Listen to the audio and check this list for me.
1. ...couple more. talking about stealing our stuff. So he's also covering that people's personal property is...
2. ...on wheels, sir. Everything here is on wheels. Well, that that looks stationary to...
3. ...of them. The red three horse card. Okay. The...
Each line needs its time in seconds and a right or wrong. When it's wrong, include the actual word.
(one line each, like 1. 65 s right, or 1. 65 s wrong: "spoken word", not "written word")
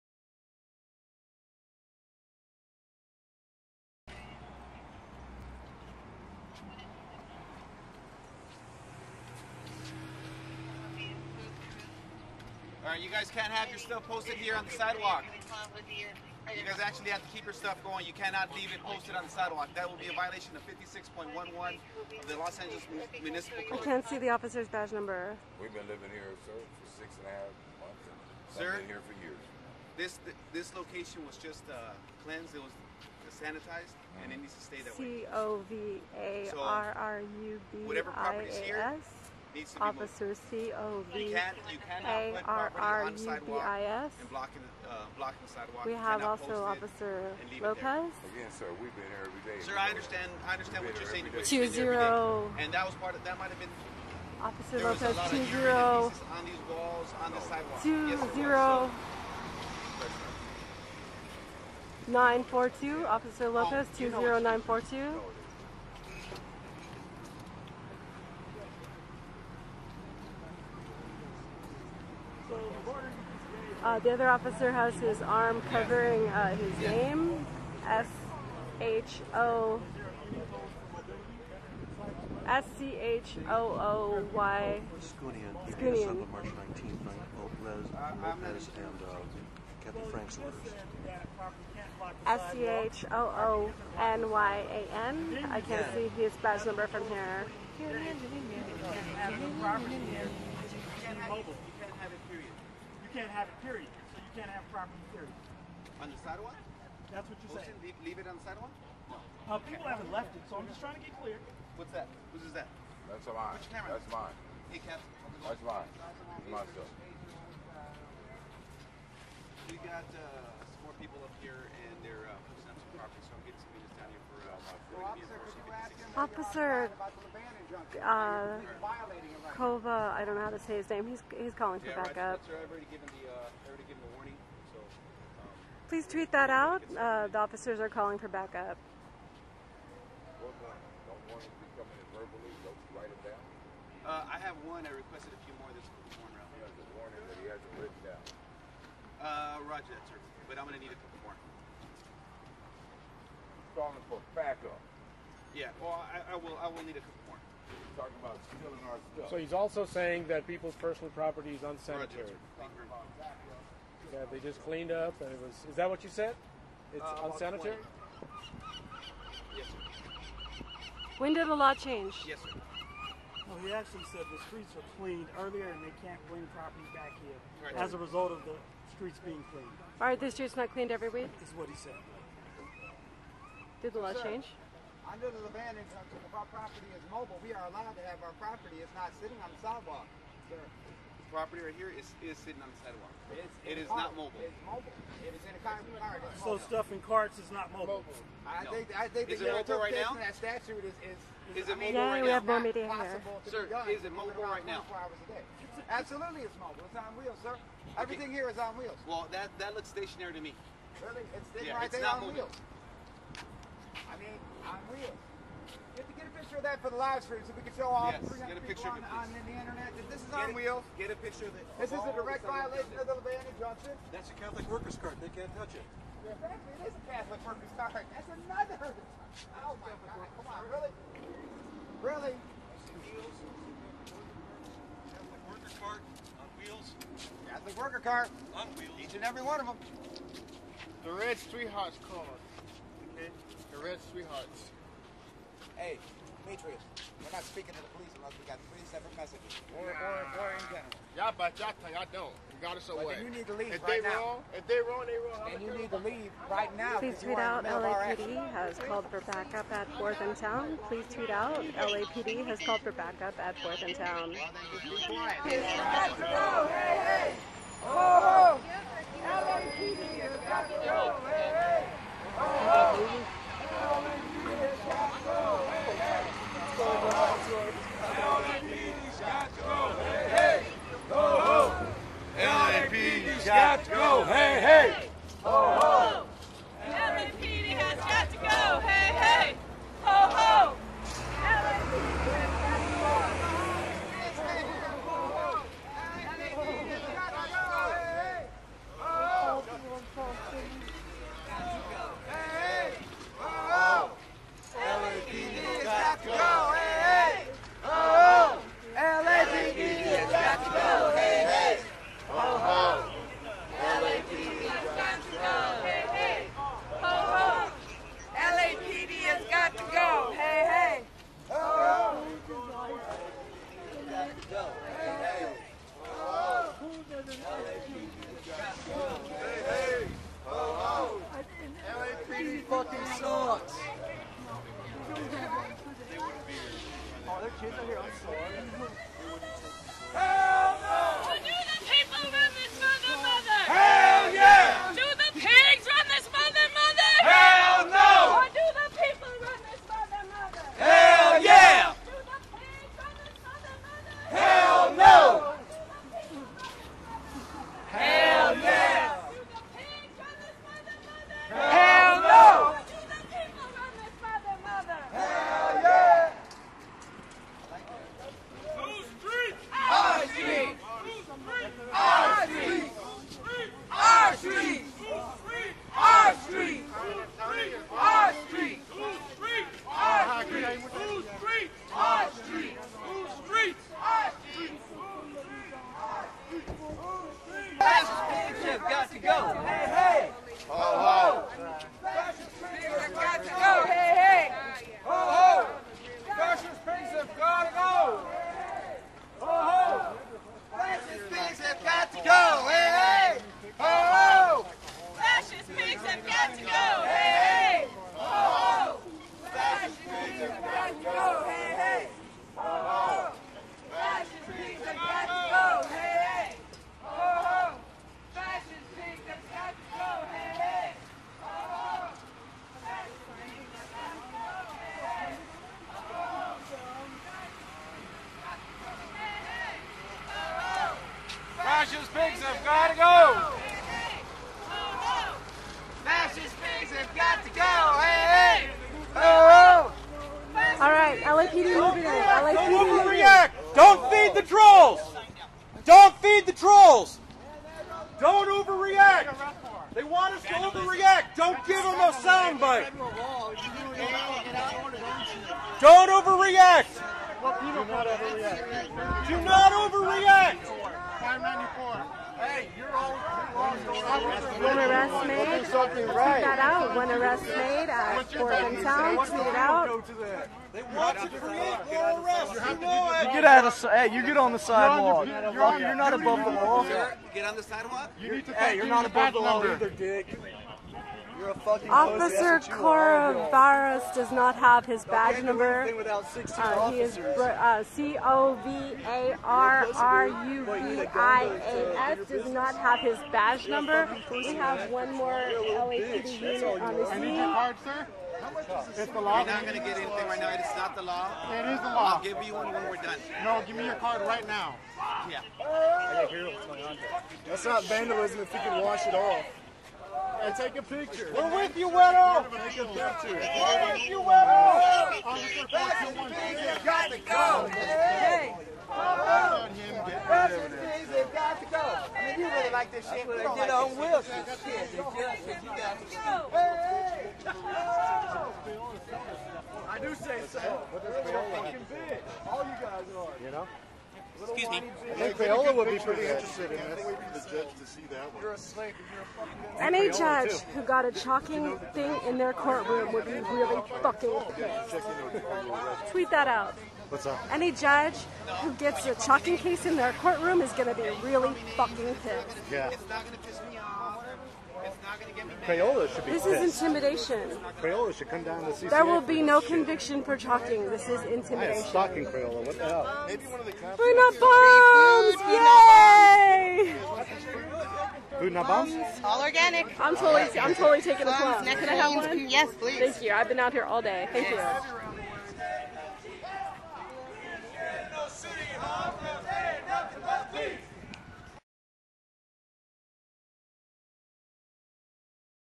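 1. 157 s wrong: "saying", not "covering"
2. 207 s right
3. 239 s right.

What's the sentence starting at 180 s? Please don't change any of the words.
Are the streets not cleaned every week?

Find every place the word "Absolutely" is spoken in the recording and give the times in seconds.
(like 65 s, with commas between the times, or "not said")
205 s.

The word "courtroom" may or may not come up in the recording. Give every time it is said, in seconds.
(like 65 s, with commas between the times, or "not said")
542 s, 550 s.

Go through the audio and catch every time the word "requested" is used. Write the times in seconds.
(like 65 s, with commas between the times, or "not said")
144 s.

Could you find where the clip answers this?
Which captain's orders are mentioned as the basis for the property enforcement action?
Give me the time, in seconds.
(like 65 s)
89 s.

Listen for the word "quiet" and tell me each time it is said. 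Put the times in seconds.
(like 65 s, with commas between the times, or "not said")
265 s.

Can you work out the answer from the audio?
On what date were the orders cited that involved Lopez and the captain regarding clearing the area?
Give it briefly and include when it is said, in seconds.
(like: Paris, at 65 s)
March 19th, at 85 s.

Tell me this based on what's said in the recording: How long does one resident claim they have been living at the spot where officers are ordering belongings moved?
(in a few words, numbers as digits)
6 and a half months.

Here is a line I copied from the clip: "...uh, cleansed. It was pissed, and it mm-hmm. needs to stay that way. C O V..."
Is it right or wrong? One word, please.
wrong.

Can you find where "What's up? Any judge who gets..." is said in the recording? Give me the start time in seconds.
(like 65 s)
547 s.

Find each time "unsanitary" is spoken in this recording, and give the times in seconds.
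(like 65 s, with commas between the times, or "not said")
161 s, 167 s.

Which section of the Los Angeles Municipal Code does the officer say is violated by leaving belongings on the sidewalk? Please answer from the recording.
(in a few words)
56.11.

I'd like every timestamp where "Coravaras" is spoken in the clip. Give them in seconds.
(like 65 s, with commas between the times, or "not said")
482 s.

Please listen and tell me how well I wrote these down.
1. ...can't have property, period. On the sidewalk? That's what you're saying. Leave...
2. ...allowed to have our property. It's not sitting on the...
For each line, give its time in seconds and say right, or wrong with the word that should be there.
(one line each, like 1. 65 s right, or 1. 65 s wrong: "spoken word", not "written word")
1. 104 s right
2. 187 s right.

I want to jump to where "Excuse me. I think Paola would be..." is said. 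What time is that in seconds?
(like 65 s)
534 s.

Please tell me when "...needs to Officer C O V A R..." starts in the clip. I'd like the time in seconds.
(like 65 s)
39 s.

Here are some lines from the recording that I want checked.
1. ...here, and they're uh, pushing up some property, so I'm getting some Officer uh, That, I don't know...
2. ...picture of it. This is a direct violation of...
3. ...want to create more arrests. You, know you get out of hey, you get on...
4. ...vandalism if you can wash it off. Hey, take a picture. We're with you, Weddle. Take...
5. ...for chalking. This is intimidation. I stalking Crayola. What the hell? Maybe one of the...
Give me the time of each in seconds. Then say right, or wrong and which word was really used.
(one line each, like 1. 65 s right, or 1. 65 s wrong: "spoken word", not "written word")
1. 121 s wrong: "Kova", not "That"
2. 221 s right
3. 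470 s right
4. 507 s right
5. 560 s right.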